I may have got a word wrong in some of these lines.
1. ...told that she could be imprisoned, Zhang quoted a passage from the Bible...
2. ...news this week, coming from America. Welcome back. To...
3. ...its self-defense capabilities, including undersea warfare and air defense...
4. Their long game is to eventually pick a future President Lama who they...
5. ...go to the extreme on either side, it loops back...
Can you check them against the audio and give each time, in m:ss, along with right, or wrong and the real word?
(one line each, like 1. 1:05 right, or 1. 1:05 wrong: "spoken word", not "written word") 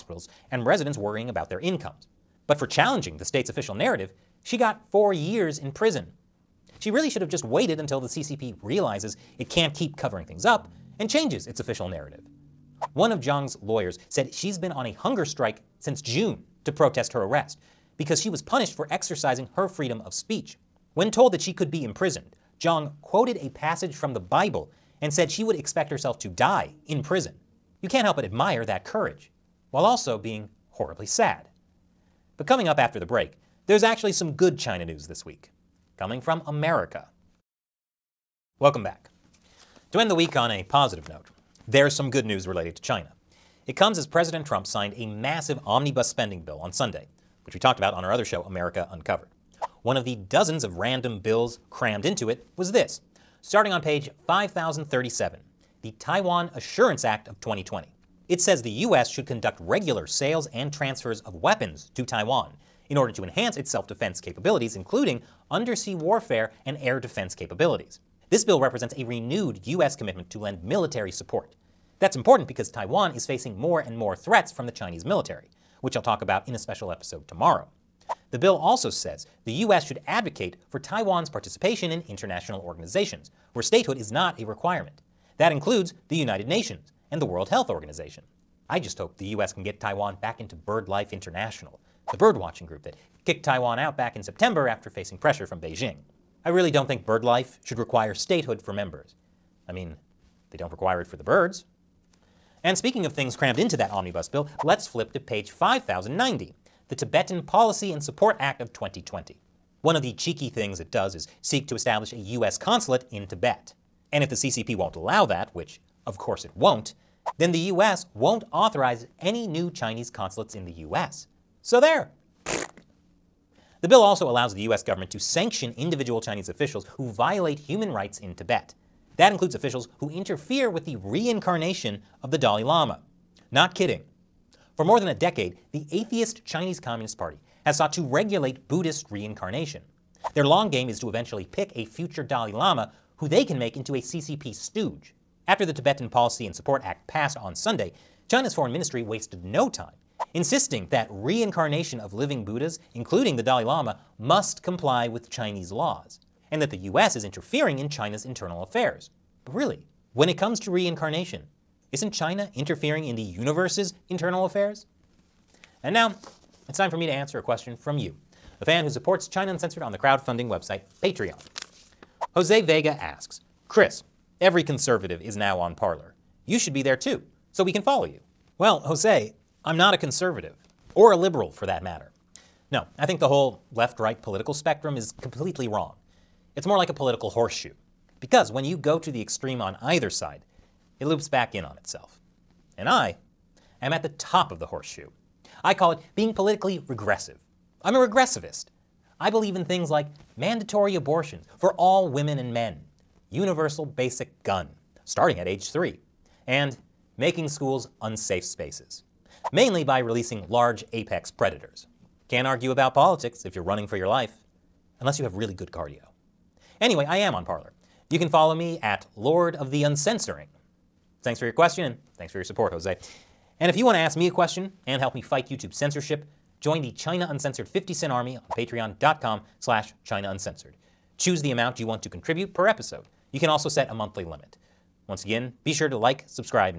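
1. 0:21 right
2. 0:34 right
3. 1:03 right
4. 2:20 wrong: "Dalai", not "President"
5. 3:08 right.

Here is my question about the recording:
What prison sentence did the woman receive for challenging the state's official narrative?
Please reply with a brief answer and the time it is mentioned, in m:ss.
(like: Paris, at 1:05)
4 years, at 0:04.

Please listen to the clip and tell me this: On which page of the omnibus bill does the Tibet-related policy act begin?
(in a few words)
5090.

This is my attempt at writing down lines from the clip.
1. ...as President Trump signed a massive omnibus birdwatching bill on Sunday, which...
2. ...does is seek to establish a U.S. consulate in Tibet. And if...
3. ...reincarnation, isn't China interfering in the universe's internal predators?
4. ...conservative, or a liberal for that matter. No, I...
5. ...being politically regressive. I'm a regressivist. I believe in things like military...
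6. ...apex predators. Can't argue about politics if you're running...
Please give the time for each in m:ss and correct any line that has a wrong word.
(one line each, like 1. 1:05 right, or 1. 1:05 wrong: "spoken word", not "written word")
1. 0:43 wrong: "spending", not "birdwatching"
2. 1:50 right
3. 2:40 wrong: "affairs", not "predators"
4. 2:59 right
5. 3:16 wrong: "mandatory", not "military"
6. 3:30 right.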